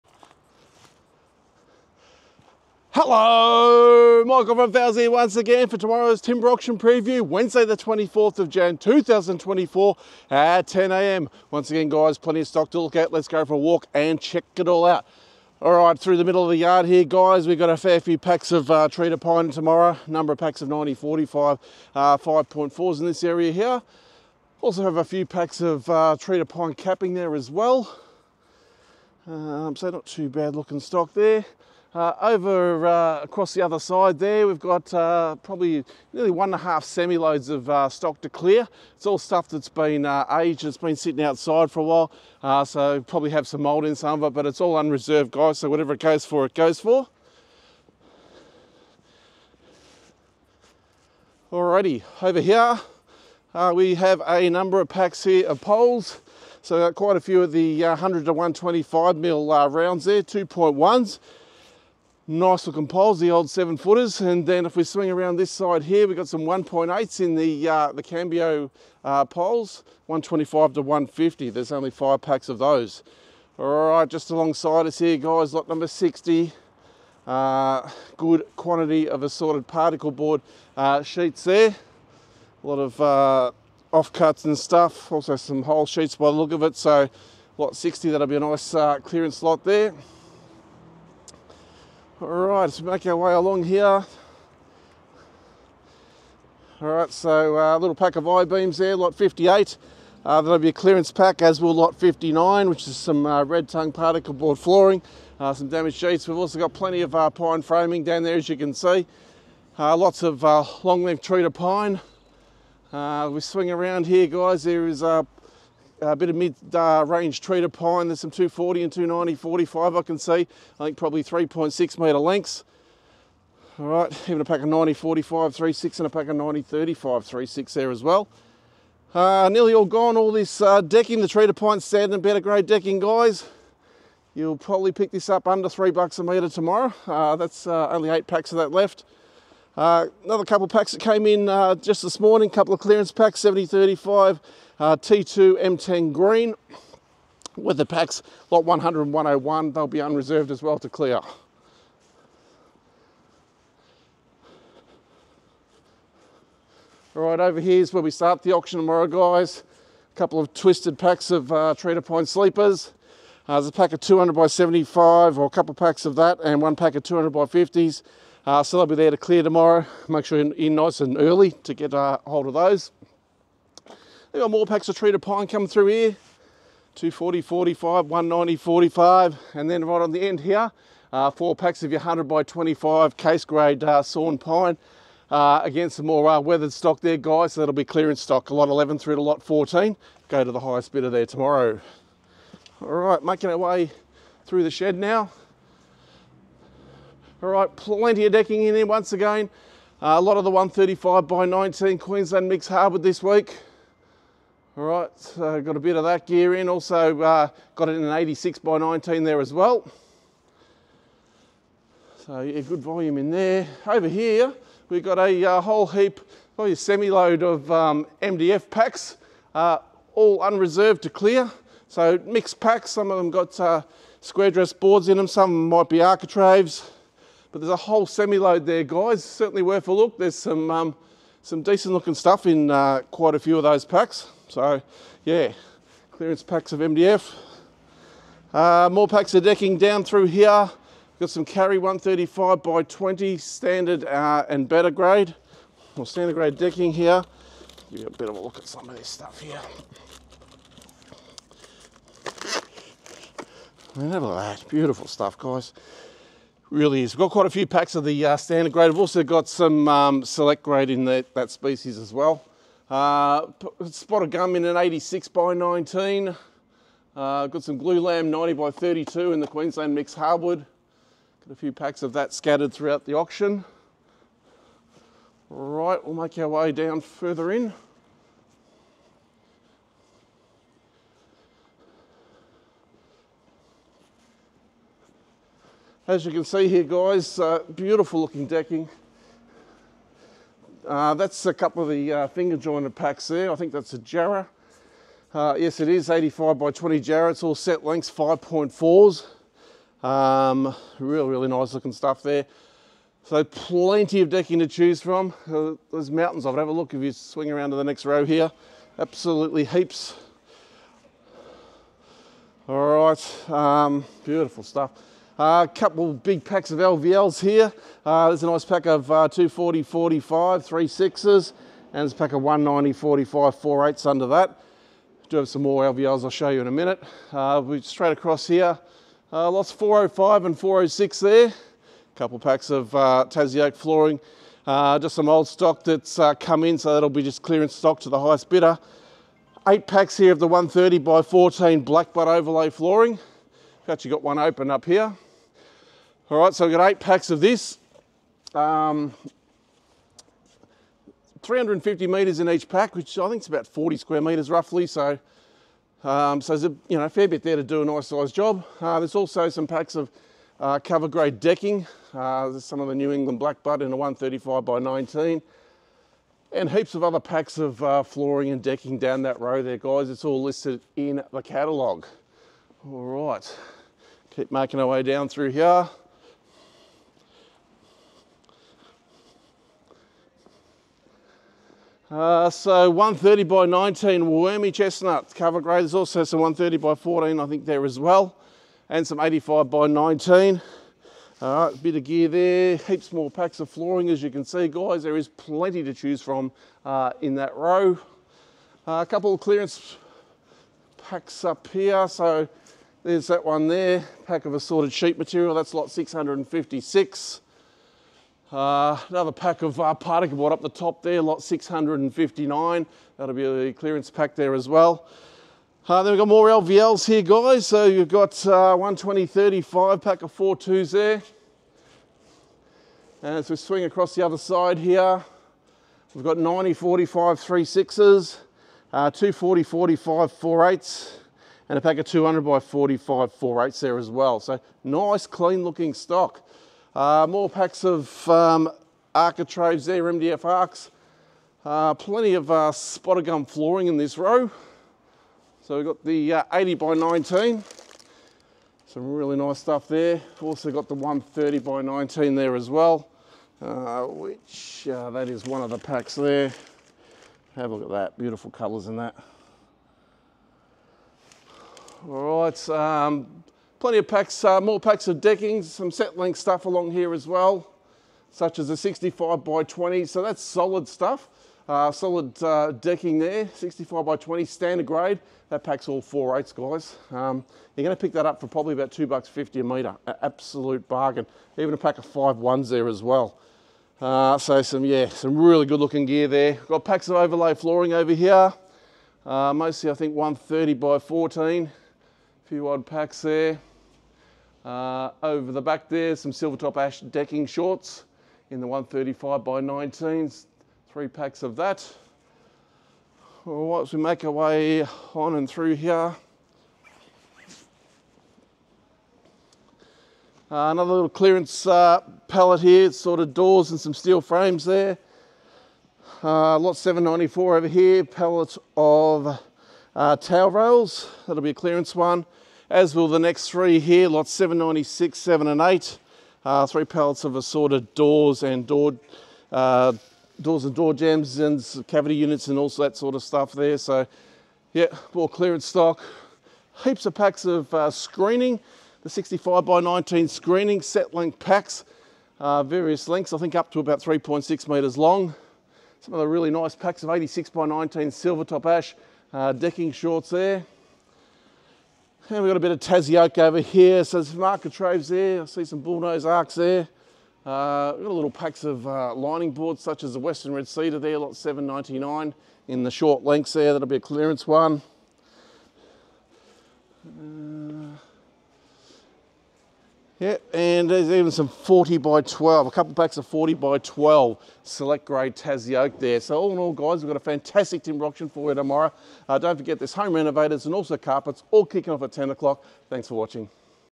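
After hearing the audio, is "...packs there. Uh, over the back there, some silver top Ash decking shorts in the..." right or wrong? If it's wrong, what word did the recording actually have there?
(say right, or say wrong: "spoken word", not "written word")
right.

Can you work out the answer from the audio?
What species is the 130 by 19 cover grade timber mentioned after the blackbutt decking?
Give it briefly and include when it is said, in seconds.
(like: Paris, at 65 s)
wormy chestnut, at 384 s.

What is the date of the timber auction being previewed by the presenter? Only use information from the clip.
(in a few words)
24 January 2024.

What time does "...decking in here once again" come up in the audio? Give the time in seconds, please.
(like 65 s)
198 s.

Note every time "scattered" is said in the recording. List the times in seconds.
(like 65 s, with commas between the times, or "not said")
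272 s.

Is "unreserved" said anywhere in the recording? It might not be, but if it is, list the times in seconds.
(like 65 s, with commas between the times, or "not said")
44 s, 150 s, 220 s.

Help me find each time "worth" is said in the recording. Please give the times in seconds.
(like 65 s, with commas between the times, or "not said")
229 s.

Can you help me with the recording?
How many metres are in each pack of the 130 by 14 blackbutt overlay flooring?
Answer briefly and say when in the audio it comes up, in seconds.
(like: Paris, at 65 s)
350 metres, at 351 s.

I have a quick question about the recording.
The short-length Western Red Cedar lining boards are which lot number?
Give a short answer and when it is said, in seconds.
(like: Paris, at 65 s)
799, at 561 s.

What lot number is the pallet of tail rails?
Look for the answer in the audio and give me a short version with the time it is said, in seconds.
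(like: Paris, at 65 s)
794, at 516 s.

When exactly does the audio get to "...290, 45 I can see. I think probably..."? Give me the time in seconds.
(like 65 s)
118 s.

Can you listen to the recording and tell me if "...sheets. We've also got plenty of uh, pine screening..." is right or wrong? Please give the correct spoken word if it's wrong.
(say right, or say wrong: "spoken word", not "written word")
wrong: "framing", not "screening".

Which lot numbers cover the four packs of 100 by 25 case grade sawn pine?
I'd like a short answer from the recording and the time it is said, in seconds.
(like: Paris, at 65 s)
lots 11 to 14, at 188 s.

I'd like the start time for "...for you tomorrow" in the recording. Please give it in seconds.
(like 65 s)
578 s.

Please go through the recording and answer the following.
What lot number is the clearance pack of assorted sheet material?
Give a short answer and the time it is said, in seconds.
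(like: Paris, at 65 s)
656, at 405 s.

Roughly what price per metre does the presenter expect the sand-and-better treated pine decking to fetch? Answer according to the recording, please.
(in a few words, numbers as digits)
under $3 a metre.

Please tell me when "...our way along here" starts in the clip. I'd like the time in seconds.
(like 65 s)
93 s.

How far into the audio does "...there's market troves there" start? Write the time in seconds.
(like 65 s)
554 s.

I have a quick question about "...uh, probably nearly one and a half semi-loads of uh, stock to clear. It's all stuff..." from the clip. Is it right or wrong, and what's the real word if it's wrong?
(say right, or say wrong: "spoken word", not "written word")
right.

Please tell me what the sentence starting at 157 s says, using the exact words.
All right, over here is where we start the auction tomorrow, guys.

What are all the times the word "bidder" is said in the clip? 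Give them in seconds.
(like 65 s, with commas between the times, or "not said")
190 s, 338 s.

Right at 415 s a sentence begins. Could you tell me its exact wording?
Uh, then we've got more LVLs here, guys.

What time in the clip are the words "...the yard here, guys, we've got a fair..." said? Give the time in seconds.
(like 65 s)
16 s.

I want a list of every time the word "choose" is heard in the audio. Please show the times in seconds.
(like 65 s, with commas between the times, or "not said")
304 s, 395 s.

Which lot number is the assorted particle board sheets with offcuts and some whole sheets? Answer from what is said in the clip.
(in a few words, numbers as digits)
60.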